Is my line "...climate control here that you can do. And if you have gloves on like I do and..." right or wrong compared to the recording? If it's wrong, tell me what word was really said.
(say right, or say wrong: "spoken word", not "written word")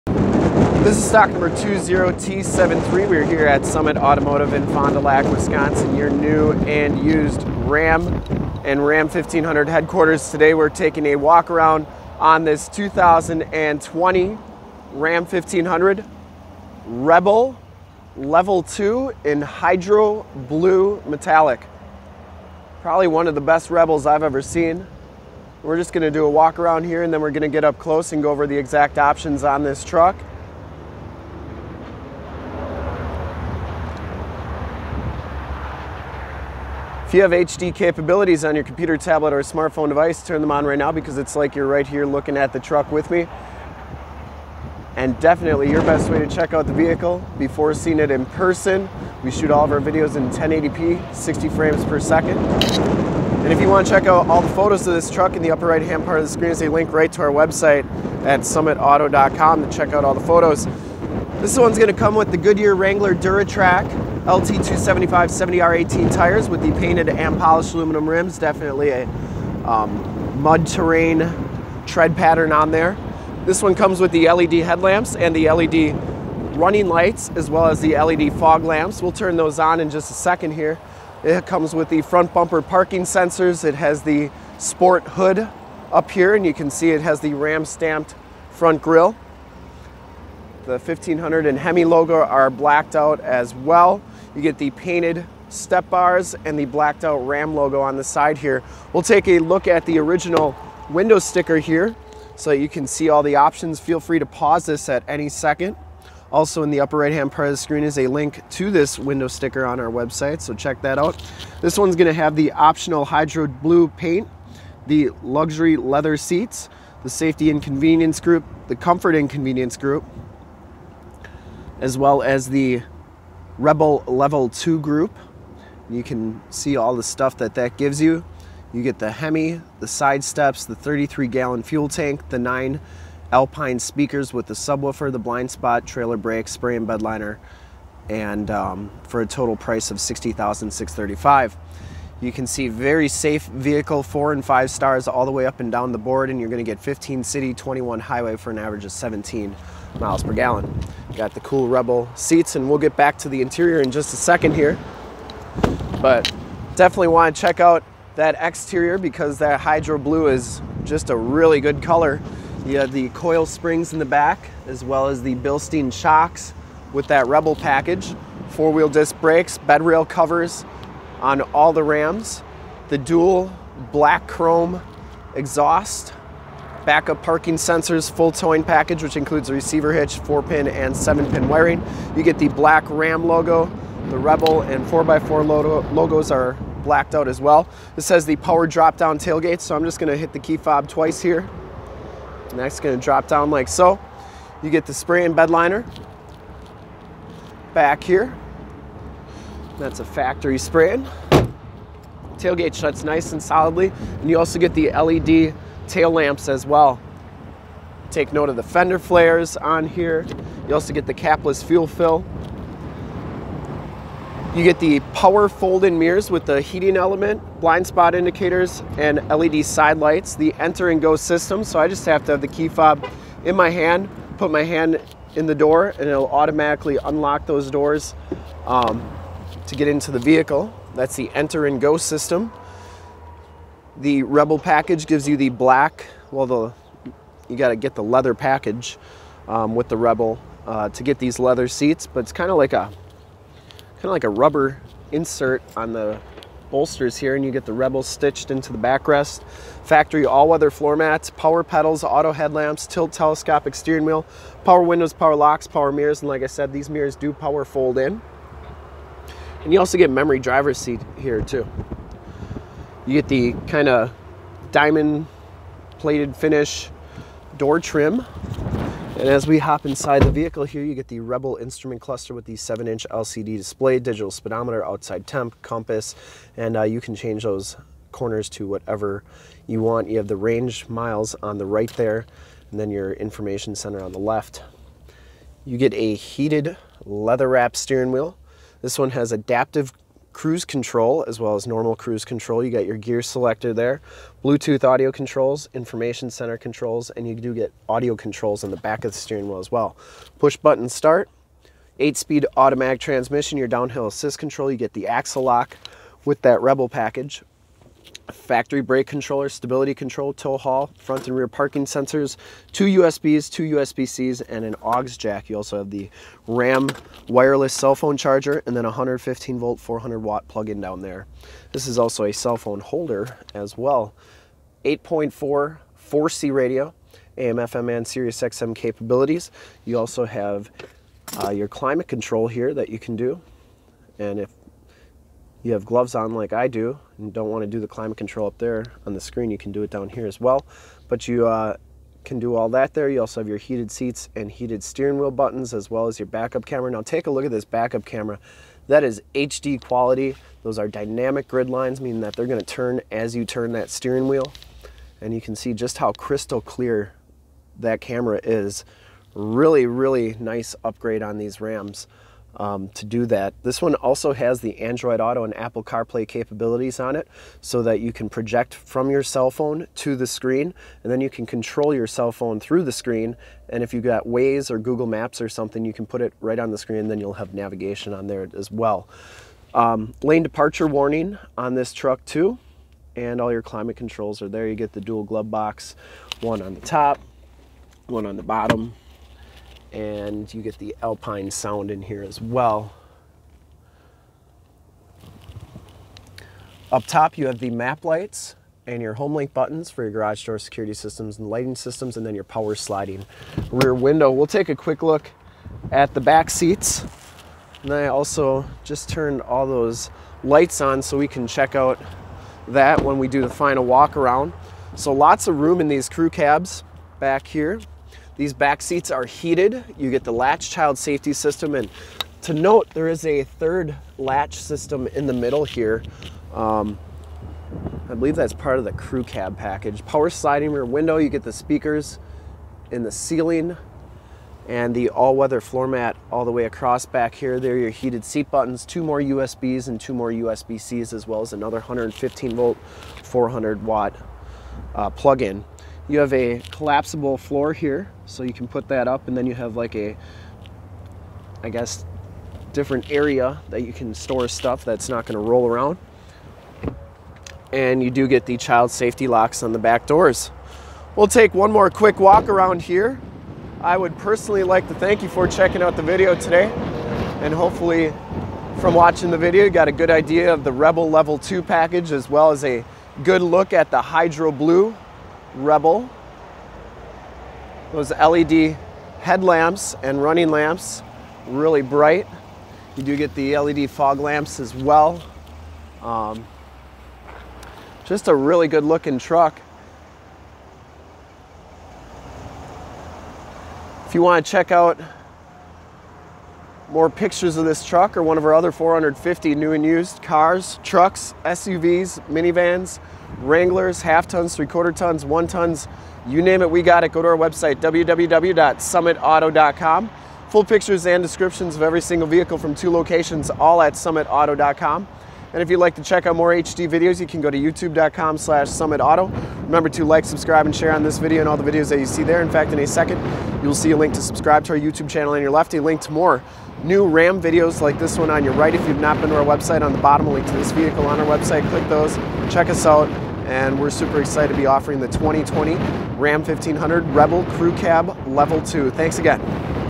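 right.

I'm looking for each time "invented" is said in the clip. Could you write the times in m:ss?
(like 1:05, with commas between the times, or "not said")
not said.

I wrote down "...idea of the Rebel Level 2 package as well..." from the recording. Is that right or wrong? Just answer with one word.
right.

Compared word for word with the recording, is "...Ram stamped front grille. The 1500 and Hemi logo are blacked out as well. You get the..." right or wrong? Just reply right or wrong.
right.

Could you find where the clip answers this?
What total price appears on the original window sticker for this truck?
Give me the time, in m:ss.
2:20.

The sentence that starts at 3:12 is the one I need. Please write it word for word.
And that's gonna drop down like so.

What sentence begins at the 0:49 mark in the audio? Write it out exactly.
We shoot all of our videos in 1080p, 60 frames per second.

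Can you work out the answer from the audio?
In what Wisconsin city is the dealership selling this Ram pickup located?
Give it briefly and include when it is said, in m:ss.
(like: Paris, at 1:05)
Fond du Lac, at 0:04.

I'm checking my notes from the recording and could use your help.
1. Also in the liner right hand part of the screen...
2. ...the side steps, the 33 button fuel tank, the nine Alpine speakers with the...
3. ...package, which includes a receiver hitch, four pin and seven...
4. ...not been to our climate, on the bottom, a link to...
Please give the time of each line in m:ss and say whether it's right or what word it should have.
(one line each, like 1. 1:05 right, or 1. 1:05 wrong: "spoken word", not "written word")
1. 1:46 wrong: "upper", not "liner"
2. 2:09 wrong: "gallon", not "button"
3. 2:58 right
4. 8:49 wrong: "website", not "climate".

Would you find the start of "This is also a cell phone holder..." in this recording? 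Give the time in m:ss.
5:21.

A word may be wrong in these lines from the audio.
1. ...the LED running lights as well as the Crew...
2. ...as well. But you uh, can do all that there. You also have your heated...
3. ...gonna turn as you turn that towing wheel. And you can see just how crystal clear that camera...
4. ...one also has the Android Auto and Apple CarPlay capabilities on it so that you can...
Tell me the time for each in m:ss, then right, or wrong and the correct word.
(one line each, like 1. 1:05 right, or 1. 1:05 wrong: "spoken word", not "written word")
1. 1:15 wrong: "LED", not "Crew"
2. 5:40 right
3. 5:52 wrong: "steering", not "towing"
4. 6:03 right.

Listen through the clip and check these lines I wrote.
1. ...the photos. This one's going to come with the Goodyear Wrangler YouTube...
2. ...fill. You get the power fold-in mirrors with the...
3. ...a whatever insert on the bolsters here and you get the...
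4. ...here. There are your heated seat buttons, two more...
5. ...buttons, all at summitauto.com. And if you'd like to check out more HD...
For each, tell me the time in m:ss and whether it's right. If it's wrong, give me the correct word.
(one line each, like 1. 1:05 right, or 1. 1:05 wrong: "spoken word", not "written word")
1. 1:00 wrong: "DuraTrac", not "YouTube"
2. 3:31 right
3. 4:04 wrong: "rubber", not "whatever"
4. 7:17 right
5. 8:32 wrong: "locations", not "buttons".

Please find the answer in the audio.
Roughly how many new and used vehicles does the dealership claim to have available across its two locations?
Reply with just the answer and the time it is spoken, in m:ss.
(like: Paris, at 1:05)
450, at 8:18.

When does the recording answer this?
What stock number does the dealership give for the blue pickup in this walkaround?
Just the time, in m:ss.
0:01.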